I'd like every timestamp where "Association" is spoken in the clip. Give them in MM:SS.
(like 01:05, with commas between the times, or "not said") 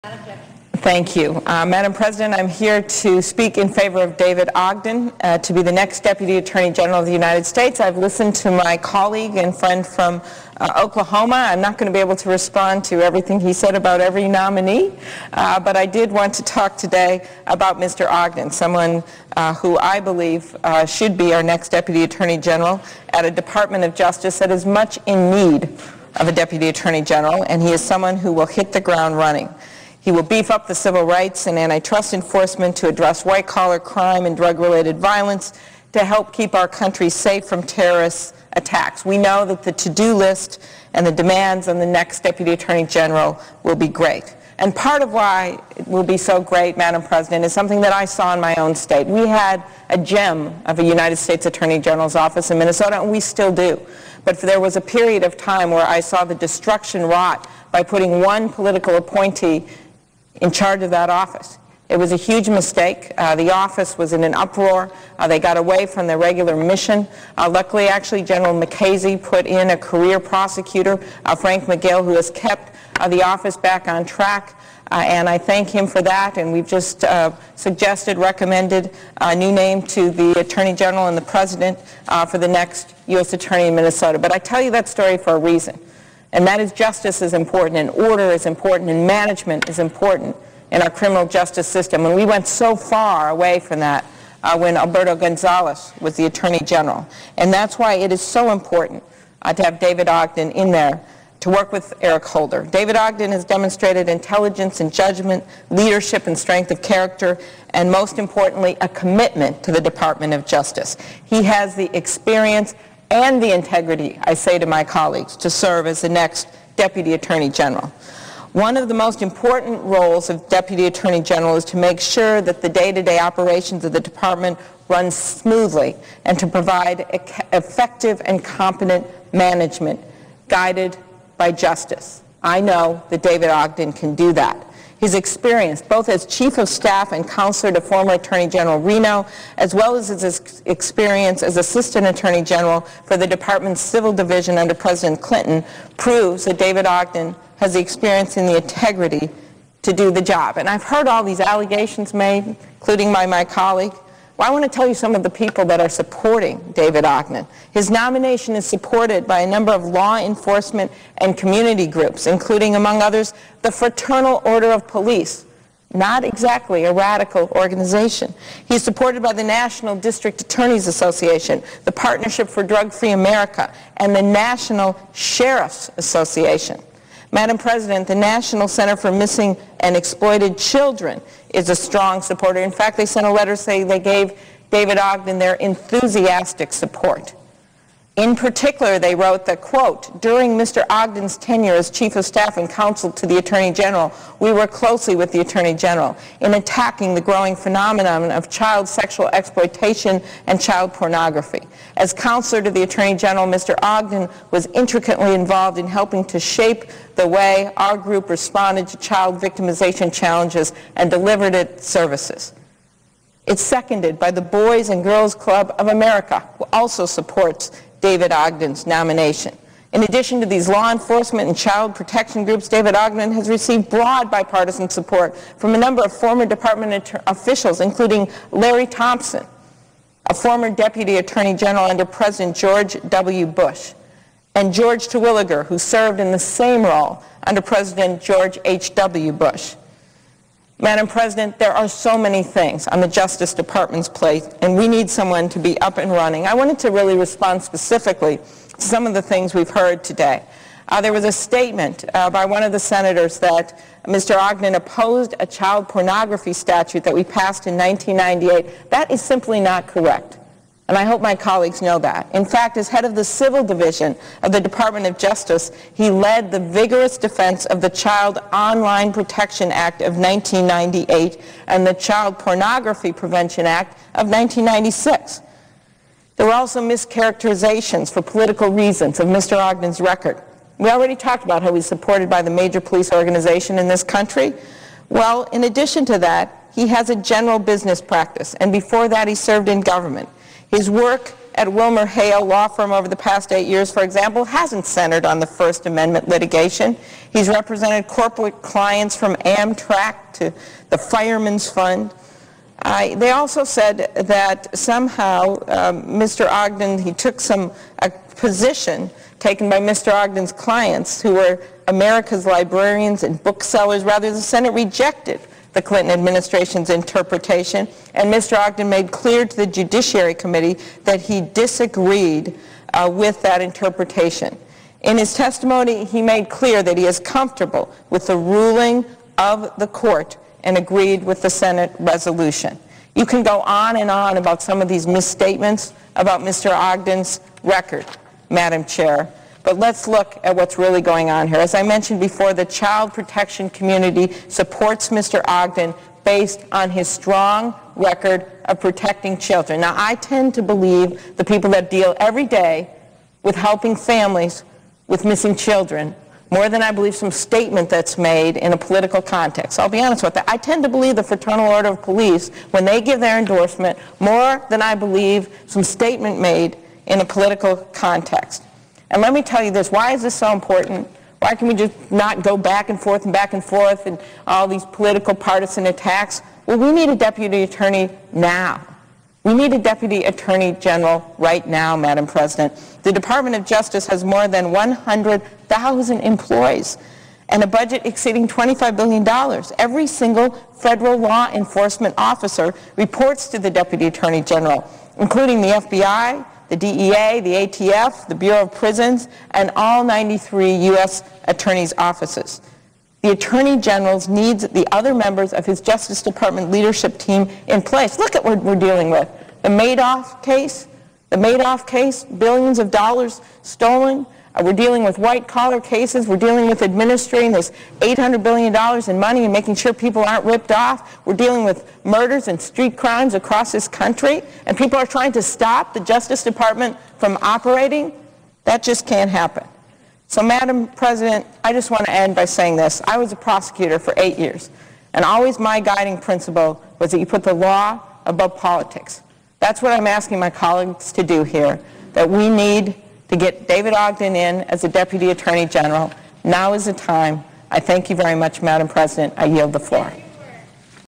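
02:50, 02:55.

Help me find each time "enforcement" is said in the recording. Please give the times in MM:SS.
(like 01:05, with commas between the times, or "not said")
00:32, 02:40, 03:40, 06:31.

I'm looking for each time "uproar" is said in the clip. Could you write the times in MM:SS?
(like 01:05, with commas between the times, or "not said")
01:04.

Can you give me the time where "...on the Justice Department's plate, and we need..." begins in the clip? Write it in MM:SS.
04:02.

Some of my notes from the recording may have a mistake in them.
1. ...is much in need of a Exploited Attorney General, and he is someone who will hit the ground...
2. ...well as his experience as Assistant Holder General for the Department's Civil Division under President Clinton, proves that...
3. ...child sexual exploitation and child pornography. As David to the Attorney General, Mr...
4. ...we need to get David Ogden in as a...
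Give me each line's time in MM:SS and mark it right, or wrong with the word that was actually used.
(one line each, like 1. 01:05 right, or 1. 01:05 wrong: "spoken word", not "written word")
1. 00:24 wrong: "Deputy", not "Exploited"
2. 02:19 wrong: "Attorney", not "Holder"
3. 03:18 wrong: "Counselor", not "David"
4. 07:22 right.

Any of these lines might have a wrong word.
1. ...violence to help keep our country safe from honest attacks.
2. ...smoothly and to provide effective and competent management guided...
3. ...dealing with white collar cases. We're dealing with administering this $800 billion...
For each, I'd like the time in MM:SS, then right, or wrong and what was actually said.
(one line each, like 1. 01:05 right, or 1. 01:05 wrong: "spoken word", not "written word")
1. 00:34 wrong: "terrorist", not "honest"
2. 02:05 right
3. 06:54 right.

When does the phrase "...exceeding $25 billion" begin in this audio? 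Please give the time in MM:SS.
06:28.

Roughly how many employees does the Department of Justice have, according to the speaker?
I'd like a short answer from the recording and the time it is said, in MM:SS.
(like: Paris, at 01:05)
more than 100,000, at 06:24.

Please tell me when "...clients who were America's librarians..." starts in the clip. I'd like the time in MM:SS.
05:10.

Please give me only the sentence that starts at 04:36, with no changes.
There were also mischaracterizations for political reasons of Mr.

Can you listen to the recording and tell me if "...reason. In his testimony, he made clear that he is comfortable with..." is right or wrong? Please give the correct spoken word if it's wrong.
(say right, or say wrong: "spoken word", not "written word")
wrong: "interpretation", not "reason".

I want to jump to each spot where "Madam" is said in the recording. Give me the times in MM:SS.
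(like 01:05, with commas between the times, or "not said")
00:01, 00:46, 02:57, 04:00, 05:38, 06:21, 07:10, 07:28.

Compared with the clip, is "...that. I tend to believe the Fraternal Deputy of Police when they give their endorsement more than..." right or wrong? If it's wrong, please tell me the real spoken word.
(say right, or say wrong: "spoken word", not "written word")
wrong: "Order", not "Deputy".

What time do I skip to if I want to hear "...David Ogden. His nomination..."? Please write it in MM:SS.
02:36.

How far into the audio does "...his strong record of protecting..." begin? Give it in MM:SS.
05:46.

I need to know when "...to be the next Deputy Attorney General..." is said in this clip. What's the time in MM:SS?
00:05.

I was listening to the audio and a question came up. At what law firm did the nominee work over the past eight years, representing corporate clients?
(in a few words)
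Wilmer Hale.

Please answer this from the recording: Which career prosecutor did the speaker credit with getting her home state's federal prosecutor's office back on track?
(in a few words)
Frank Magill.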